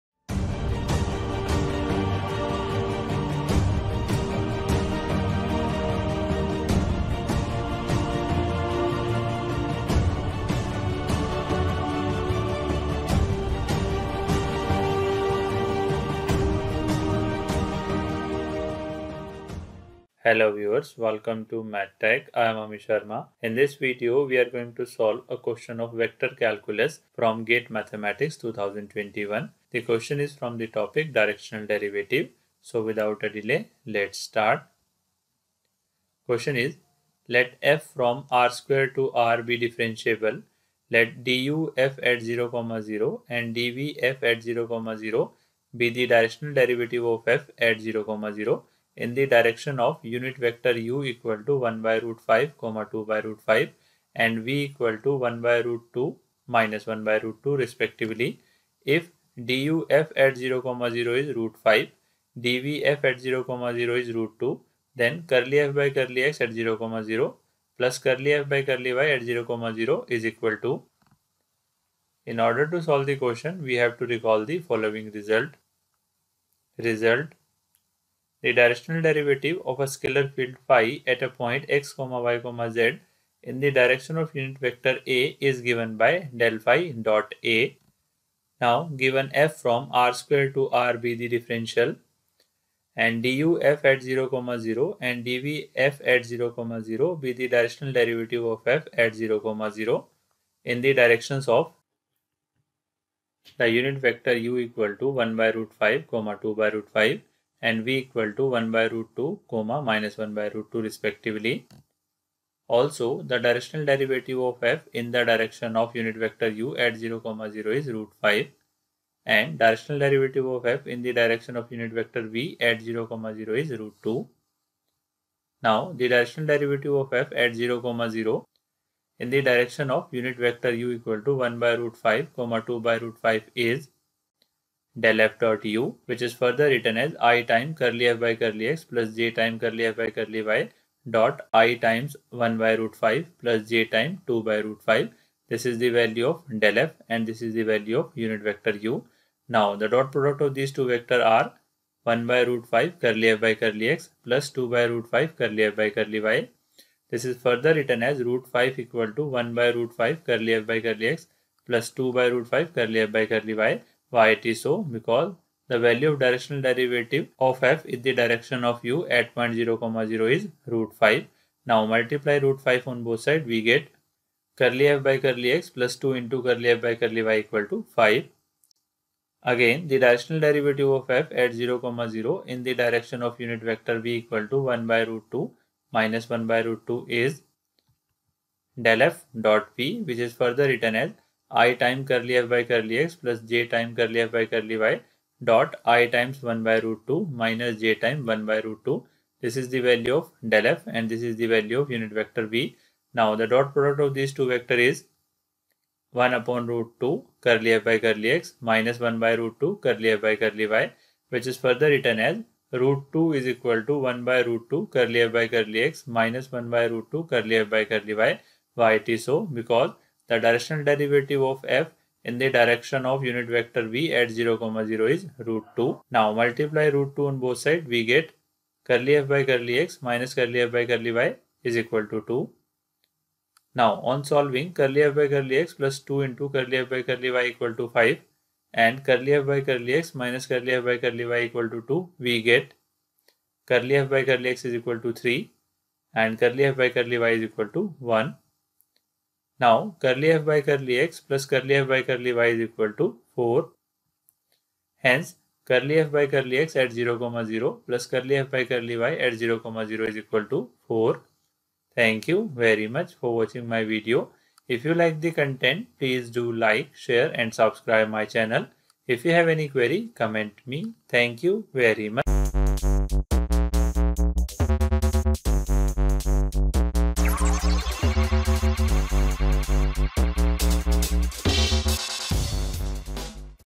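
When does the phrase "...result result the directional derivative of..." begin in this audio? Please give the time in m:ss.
1:15.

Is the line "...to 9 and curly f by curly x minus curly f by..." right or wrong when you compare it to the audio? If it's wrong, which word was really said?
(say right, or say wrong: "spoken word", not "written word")
wrong: "5", not "9".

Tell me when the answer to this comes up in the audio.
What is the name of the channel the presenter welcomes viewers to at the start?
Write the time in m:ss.
0:21.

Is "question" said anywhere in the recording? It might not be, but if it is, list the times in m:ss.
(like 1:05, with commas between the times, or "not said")
0:25, 0:29, 0:36, 1:13.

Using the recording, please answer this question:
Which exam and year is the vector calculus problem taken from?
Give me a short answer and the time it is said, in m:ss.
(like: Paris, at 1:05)
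GATE Mathematics 2021, at 0:27.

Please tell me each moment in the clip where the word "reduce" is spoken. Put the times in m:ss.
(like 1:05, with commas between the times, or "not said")
not said.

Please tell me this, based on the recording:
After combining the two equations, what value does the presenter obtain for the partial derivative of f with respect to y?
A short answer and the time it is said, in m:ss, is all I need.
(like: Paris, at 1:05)
1, at 4:06.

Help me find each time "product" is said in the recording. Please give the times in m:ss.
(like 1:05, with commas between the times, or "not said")
2:30, 3:23.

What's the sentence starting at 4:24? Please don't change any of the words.
If you like the content, please do like, share and subscribe my channel.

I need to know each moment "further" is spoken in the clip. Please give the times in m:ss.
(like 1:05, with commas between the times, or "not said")
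2:16, 2:37, 3:10, 3:31.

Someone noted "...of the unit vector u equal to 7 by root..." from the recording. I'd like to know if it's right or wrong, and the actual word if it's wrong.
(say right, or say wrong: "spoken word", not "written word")
wrong: "1", not "7".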